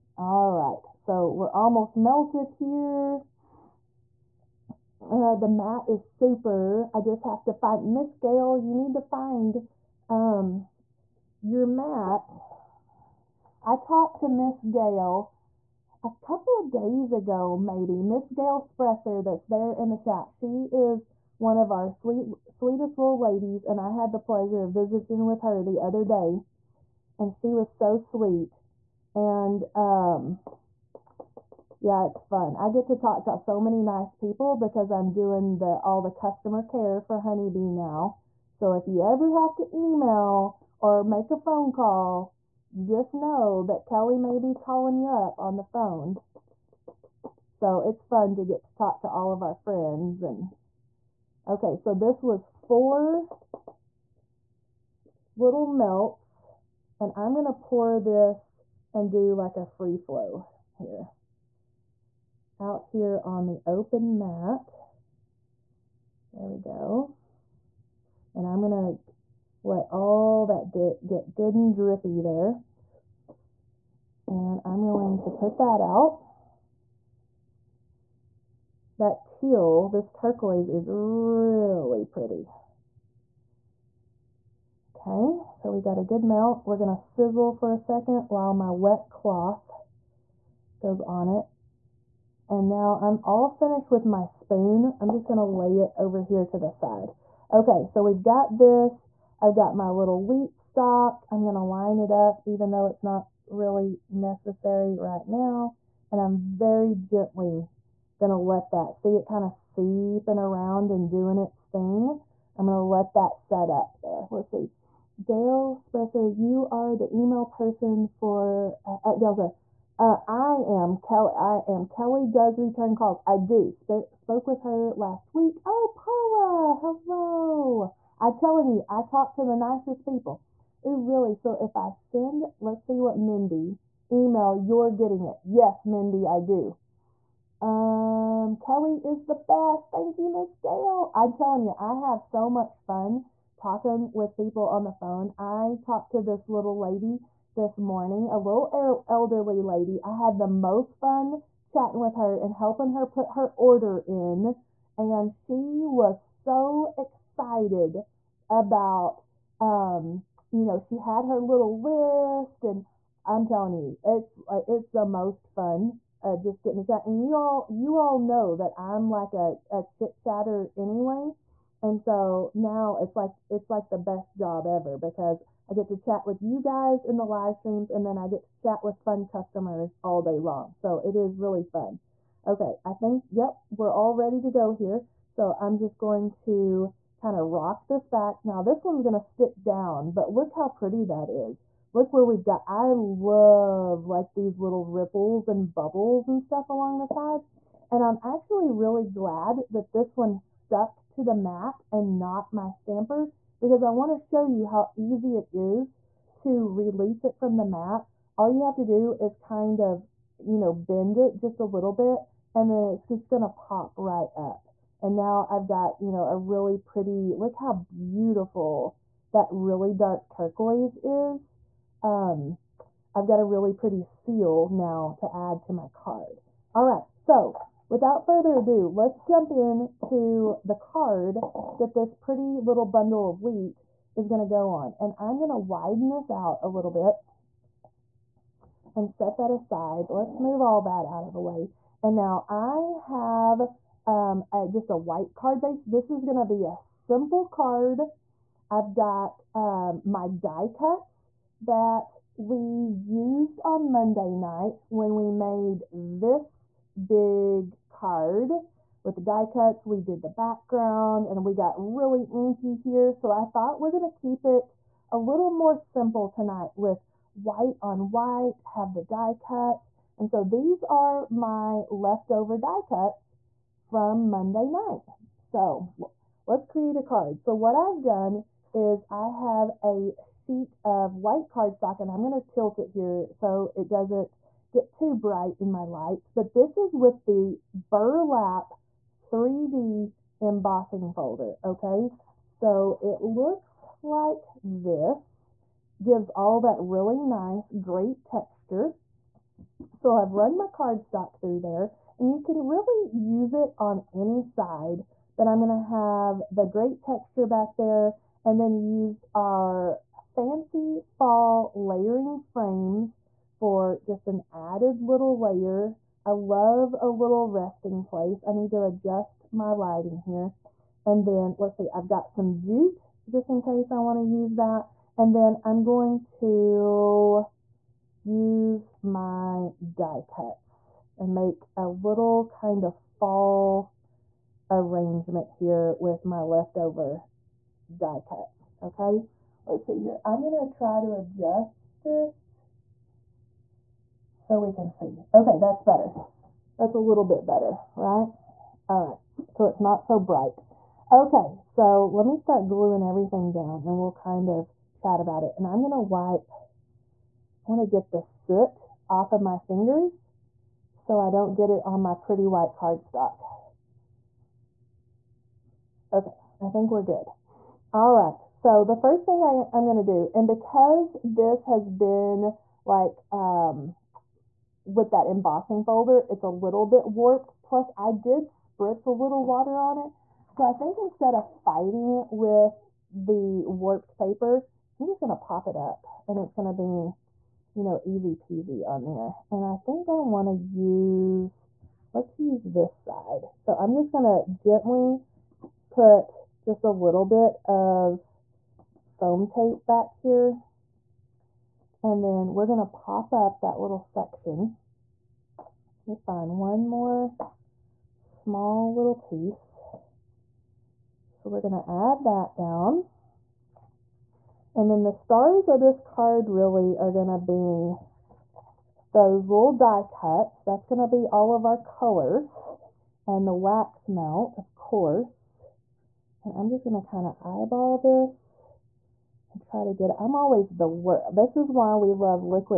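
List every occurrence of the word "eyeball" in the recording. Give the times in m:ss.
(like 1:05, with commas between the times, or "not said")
7:07.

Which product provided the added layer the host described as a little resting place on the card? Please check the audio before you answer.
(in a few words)
fancy fall layering frames.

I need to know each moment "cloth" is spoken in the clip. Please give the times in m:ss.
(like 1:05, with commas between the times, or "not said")
1:29.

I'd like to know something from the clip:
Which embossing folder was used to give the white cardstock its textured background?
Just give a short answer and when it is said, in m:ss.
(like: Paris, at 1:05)
burlap 3D, at 4:47.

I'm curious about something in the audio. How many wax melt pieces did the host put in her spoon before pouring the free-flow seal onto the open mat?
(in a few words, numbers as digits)
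4.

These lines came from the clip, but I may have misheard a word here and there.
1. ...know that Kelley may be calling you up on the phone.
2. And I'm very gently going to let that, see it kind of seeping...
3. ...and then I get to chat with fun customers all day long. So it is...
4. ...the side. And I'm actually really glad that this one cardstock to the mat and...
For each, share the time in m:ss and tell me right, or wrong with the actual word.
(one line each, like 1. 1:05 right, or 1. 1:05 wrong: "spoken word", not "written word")
1. 0:43 right
2. 1:46 right
3. 2:57 right
4. 3:16 wrong: "stuck", not "cardstock".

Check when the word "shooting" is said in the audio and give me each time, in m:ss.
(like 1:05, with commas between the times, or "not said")
not said.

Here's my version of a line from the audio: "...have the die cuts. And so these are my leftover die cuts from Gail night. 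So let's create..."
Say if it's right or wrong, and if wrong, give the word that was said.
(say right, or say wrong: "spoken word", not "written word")
wrong: "Monday", not "Gail".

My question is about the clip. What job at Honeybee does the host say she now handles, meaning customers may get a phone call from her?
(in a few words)
customer care.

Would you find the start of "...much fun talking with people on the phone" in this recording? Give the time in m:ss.
2:22.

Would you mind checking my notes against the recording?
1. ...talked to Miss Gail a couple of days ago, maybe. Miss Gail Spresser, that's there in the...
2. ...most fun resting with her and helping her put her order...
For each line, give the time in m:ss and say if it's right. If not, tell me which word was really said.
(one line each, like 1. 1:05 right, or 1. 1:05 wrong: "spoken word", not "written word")
1. 0:13 right
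2. 2:30 wrong: "chatting", not "resting".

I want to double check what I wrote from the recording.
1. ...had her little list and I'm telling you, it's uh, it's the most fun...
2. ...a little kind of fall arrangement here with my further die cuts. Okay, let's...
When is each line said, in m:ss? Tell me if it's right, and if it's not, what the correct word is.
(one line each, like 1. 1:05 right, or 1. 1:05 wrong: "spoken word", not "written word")
1. 2:40 right
2. 5:31 wrong: "leftover", not "further".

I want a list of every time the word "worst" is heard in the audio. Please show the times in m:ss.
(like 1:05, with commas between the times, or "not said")
7:10.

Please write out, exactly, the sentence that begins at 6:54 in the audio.
And then the stars of this card really are going to be those little die cuts.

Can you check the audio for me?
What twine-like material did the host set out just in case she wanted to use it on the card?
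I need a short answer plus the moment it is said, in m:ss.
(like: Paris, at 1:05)
jute, at 5:22.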